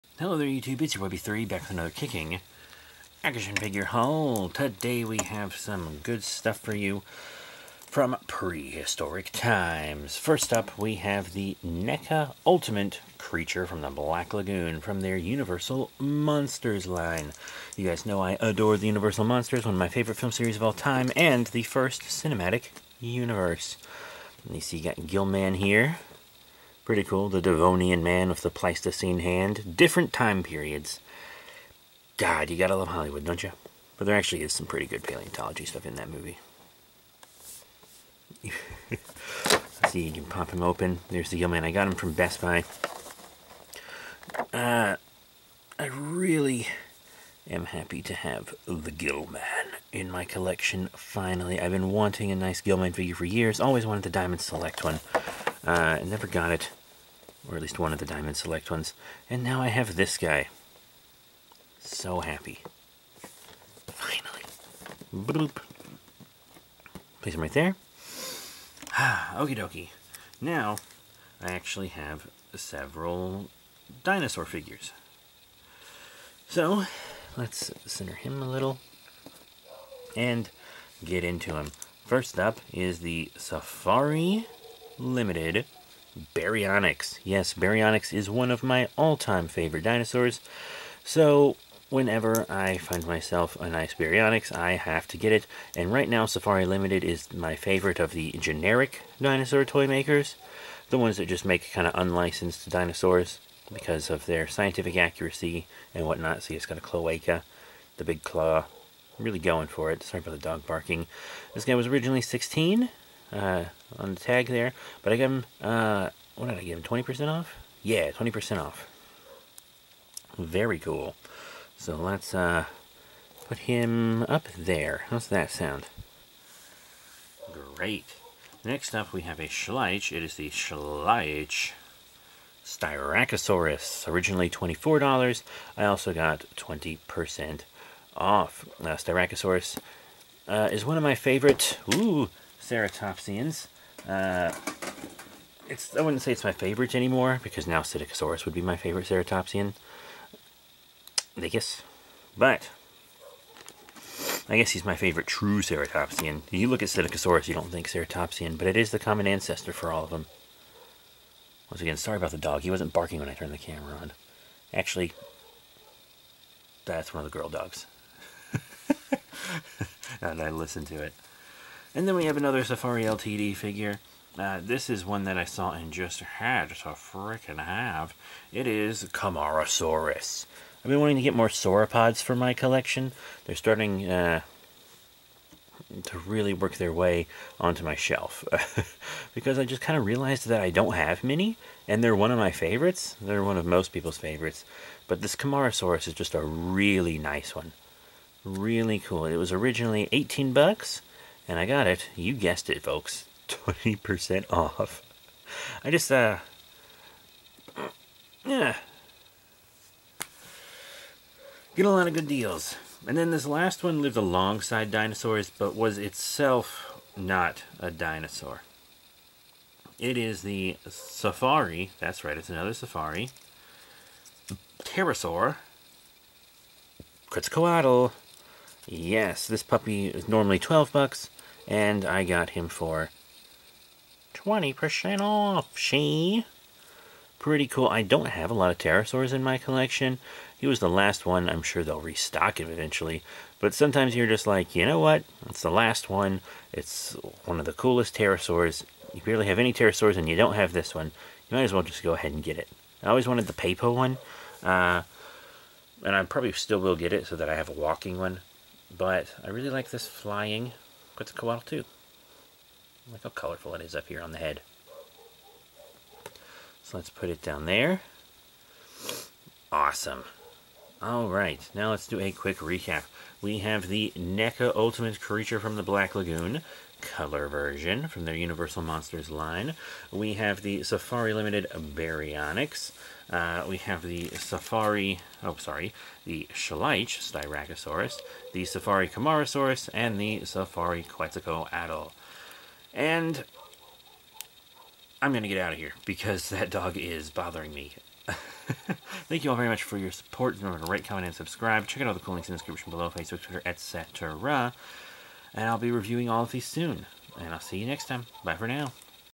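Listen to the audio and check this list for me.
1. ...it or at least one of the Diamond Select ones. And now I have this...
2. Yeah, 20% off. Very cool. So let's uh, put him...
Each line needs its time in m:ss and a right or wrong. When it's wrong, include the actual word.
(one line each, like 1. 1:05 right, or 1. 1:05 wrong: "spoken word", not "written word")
1. 0:56 right
2. 1:57 right.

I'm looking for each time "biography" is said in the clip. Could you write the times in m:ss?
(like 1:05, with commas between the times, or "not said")
not said.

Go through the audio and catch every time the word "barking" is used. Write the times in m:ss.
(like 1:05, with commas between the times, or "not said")
1:50, 2:42.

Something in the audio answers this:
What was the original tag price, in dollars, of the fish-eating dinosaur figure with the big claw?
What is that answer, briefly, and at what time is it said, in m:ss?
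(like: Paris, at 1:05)
16, at 1:52.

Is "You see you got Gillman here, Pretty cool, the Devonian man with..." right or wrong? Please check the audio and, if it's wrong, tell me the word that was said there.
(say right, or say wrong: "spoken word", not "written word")
right.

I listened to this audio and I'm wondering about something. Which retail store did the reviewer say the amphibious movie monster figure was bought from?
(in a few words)
Best Buy.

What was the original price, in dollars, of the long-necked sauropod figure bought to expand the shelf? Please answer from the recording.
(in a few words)
18.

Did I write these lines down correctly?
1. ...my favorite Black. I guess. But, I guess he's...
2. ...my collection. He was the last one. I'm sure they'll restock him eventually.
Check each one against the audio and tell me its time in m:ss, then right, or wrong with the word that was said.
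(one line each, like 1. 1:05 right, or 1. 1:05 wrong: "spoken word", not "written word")
1. 2:28 wrong: "Ceratopsian", not "Black"
2. 3:59 right.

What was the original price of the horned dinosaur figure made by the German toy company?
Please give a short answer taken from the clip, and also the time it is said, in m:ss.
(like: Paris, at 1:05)
$24, at 2:14.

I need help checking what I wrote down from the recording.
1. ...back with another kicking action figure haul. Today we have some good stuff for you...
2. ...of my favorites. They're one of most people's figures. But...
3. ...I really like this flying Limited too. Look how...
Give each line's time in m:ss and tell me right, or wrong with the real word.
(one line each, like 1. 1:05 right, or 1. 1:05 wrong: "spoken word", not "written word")
1. 0:01 right
2. 3:12 wrong: "favorites", not "figures"
3. 4:19 wrong: "Quetzalcoatl", not "Limited".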